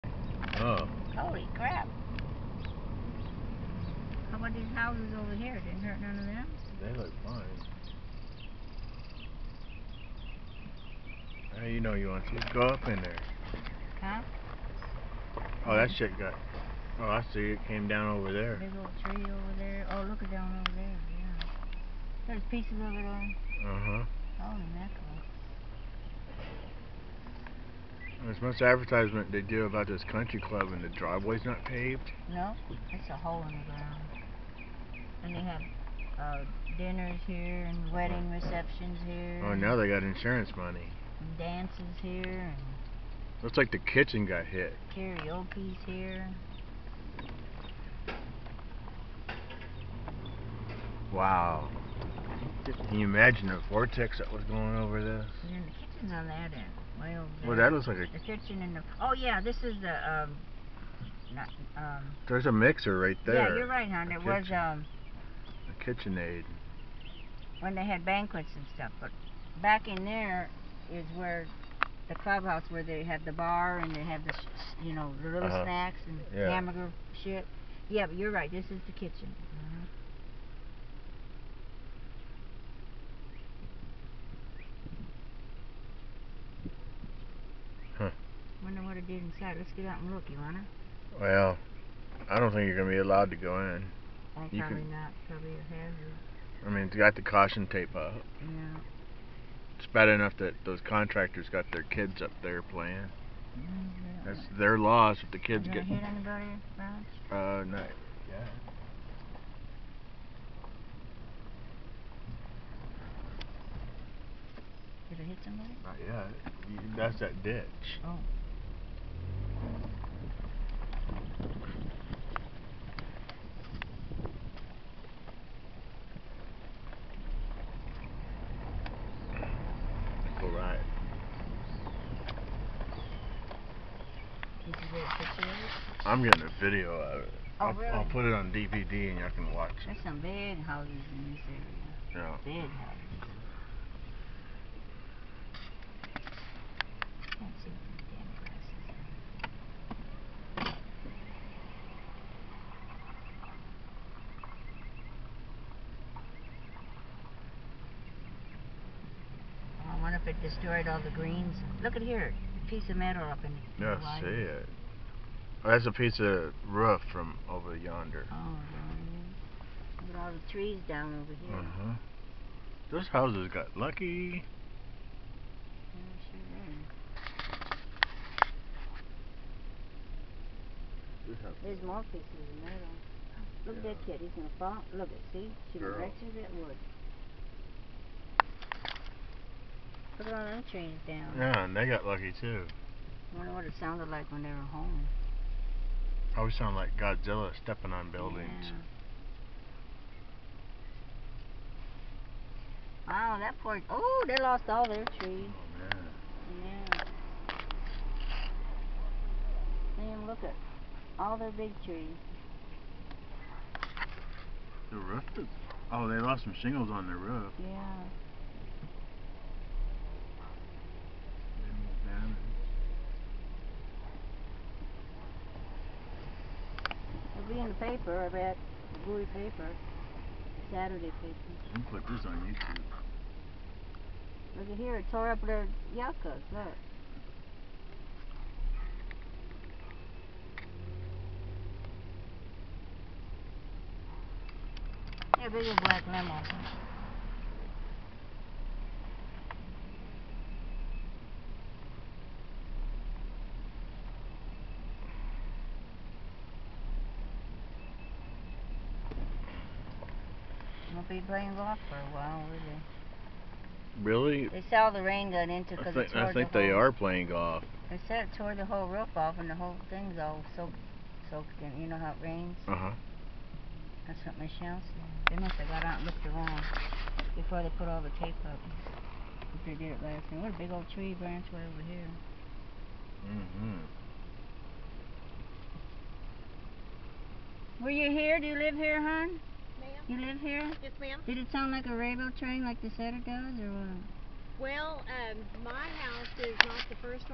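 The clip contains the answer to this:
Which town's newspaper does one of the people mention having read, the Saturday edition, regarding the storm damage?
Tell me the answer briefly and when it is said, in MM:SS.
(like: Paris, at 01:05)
Bowie, at 03:49.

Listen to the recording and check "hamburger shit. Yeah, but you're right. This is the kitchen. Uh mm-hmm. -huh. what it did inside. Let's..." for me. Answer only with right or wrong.
right.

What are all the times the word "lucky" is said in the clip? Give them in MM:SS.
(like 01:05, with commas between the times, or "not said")
02:53, 03:12.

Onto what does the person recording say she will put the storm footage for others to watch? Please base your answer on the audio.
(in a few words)
DVD.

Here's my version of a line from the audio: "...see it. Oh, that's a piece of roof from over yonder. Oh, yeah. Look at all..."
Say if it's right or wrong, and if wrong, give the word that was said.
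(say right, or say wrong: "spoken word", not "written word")
right.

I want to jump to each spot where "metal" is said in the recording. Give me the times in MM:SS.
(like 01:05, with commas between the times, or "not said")
02:42, 03:02.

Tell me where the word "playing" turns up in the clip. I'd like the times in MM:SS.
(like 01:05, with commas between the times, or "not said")
01:42, 04:21, 04:26.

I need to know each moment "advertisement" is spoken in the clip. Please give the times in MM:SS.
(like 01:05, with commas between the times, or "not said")
00:28.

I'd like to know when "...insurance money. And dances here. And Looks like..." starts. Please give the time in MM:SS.
00:40.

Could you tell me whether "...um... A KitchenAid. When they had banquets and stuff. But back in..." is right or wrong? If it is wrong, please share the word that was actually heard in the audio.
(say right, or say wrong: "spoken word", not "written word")
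right.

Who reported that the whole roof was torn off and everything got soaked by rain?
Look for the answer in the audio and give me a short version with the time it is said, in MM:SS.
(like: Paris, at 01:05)
Michelle, at 04:34.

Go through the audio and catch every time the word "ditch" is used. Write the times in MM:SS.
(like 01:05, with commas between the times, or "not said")
01:57.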